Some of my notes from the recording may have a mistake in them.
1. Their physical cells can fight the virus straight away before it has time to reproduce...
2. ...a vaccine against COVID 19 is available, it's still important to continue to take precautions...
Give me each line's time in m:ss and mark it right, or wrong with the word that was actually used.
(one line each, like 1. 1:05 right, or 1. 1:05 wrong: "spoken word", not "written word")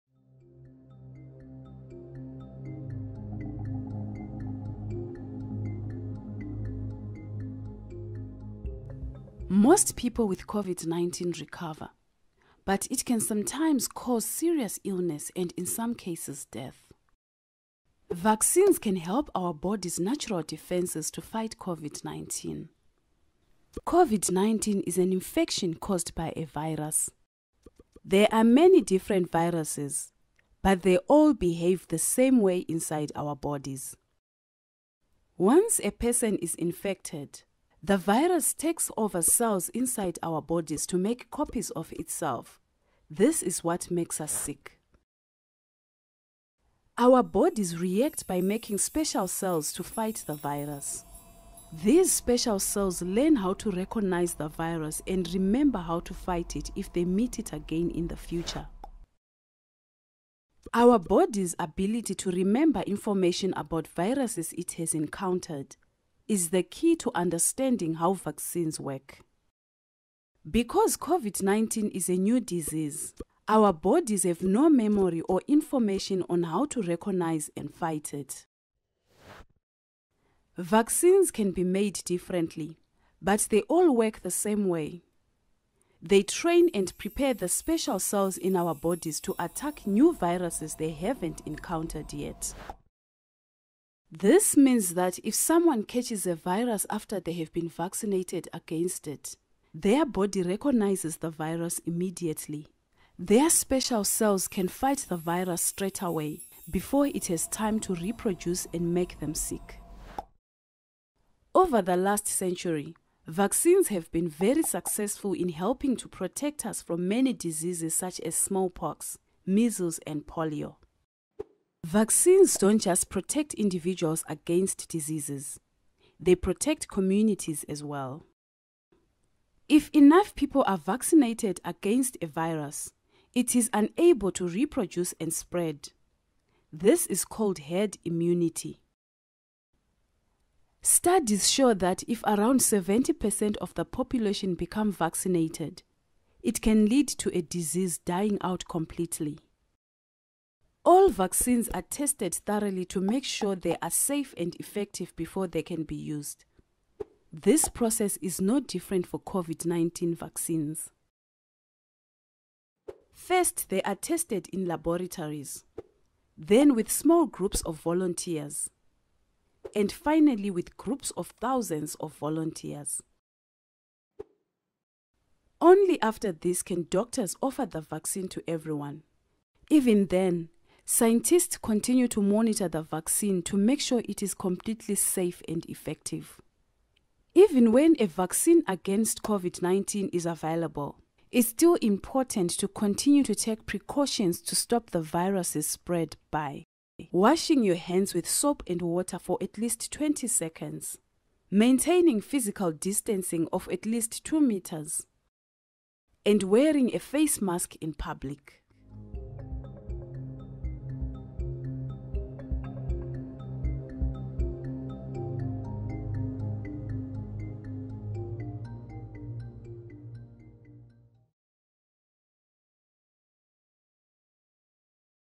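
1. 1:43 wrong: "special", not "physical"
2. 3:07 right.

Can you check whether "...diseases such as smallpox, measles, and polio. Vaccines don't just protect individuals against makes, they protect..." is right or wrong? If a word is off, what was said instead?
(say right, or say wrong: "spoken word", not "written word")
wrong: "diseases", not "makes".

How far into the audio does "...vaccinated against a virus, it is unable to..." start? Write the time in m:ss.
2:10.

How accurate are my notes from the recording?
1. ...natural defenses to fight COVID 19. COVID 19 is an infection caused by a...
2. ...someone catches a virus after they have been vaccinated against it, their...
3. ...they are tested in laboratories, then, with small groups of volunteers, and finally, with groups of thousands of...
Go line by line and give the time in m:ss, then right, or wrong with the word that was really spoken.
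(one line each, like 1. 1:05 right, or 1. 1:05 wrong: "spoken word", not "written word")
1. 0:19 right
2. 1:35 right
3. 2:43 right.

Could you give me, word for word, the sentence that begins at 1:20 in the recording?
Vaccines can be made differently, but they all work the same way.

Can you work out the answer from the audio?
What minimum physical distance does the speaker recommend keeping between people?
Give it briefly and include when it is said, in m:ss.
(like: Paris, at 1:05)
2 meters, at 3:24.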